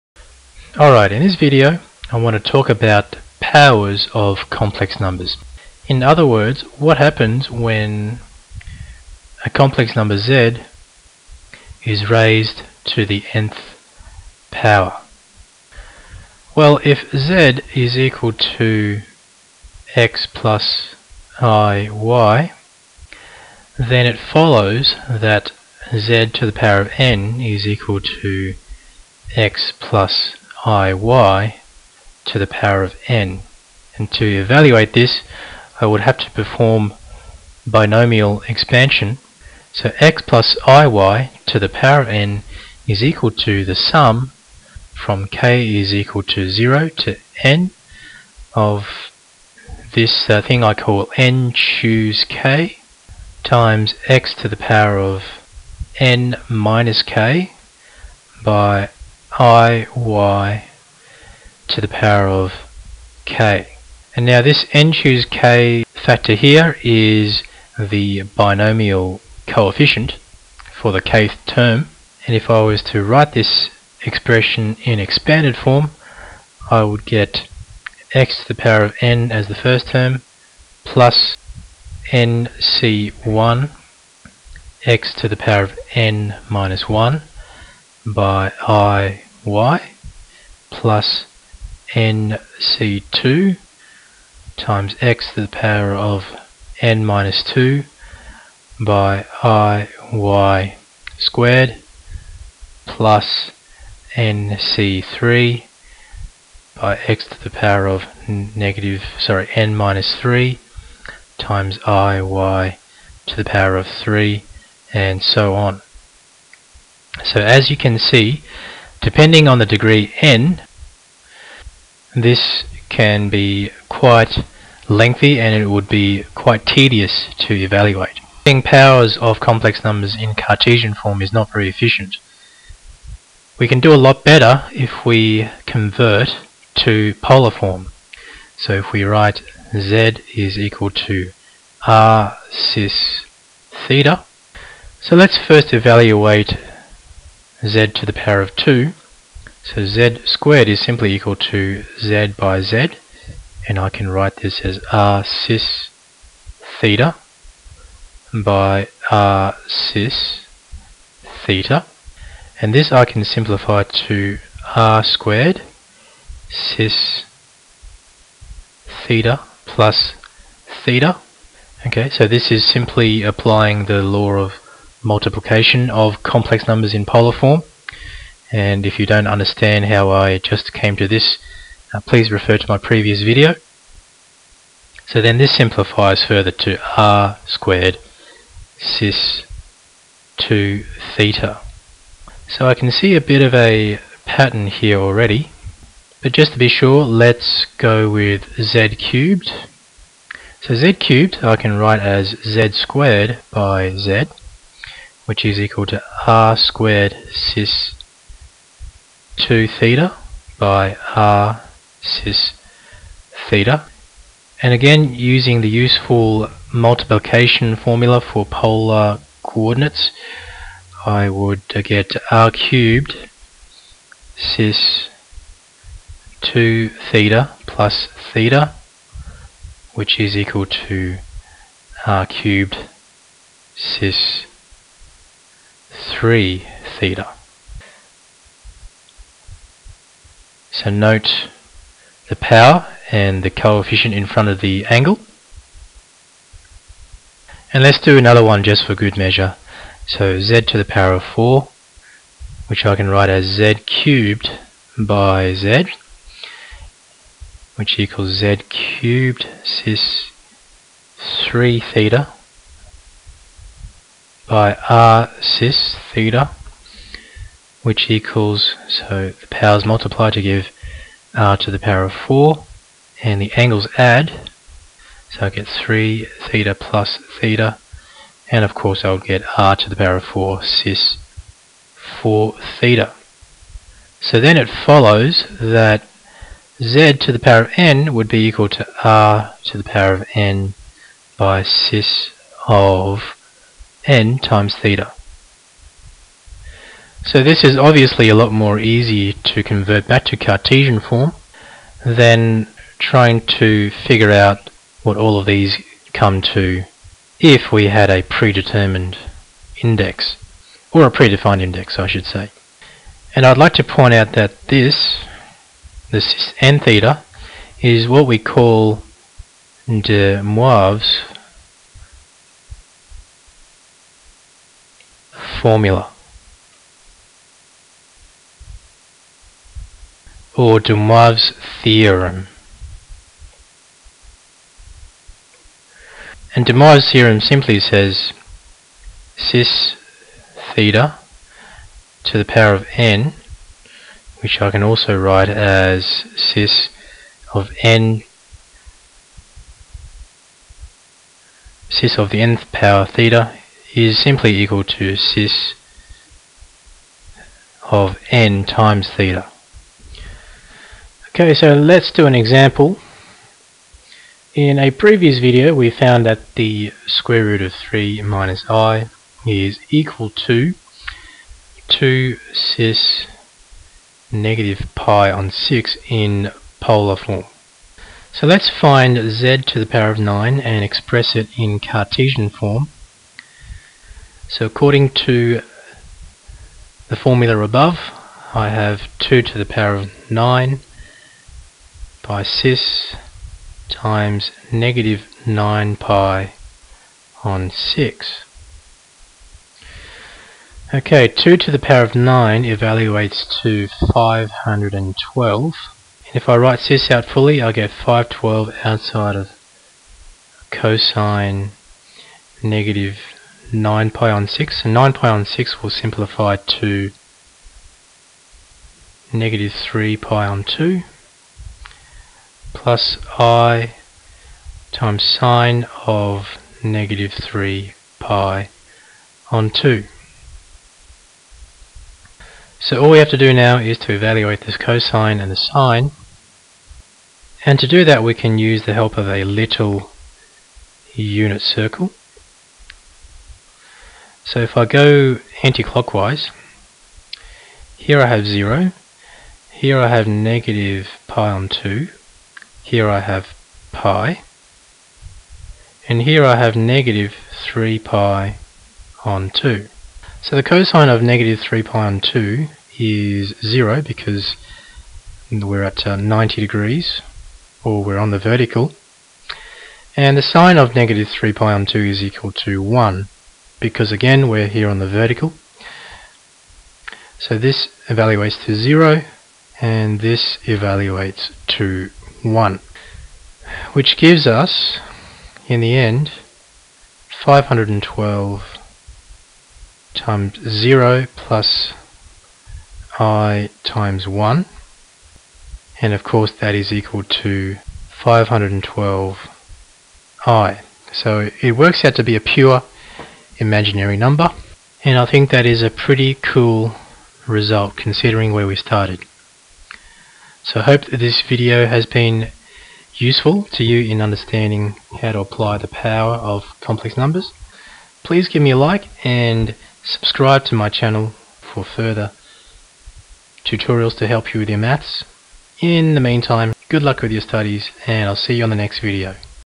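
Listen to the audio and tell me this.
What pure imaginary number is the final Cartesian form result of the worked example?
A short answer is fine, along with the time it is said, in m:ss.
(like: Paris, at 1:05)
512i, at 8:18.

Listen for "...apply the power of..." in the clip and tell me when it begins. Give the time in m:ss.
8:35.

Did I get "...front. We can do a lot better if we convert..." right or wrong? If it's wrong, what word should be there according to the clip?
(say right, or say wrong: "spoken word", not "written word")
wrong: "efficient", not "front".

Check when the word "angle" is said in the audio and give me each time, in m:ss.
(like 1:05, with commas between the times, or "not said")
4:04, 4:33.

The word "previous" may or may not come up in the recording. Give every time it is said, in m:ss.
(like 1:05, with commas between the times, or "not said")
3:02, 6:04.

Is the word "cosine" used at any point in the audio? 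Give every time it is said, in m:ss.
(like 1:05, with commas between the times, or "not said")
6:50, 7:14, 7:40.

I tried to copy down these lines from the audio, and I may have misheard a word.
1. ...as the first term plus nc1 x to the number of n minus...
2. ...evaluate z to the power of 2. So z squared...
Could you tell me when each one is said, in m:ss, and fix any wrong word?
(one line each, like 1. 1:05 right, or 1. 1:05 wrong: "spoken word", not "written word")
1. 1:19 wrong: "power", not "number"
2. 2:25 right.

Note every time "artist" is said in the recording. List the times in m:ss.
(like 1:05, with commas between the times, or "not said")
not said.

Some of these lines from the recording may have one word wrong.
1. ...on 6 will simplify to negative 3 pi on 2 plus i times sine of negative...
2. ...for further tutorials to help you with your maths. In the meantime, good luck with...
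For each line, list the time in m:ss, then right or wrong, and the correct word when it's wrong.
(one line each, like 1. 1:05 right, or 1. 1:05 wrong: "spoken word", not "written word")
1. 6:55 right
2. 8:41 right.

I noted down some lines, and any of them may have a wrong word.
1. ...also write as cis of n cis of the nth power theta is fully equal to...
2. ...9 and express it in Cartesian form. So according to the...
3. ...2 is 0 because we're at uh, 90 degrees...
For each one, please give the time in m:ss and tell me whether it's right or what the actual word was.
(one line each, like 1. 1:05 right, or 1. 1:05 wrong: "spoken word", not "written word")
1. 5:44 wrong: "simply", not "fully"
2. 6:20 right
3. 7:42 right.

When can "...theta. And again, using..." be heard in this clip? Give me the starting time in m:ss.
3:33.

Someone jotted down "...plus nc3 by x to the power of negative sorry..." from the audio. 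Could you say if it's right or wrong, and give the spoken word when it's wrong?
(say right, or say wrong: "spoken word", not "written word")
right.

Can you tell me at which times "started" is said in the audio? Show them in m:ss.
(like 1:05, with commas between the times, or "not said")
8:28.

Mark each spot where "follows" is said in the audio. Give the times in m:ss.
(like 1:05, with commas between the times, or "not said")
0:24, 4:44.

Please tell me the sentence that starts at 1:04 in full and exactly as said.
And now this n choose k factor here is the binomial coefficient for the kth term.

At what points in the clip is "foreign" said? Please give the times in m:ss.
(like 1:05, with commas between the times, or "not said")
not said.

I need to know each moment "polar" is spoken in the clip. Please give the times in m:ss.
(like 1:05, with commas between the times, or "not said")
2:17, 2:57, 3:38, 6:16.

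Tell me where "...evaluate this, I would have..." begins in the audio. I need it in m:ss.
0:34.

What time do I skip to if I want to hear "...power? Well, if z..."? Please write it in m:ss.
0:14.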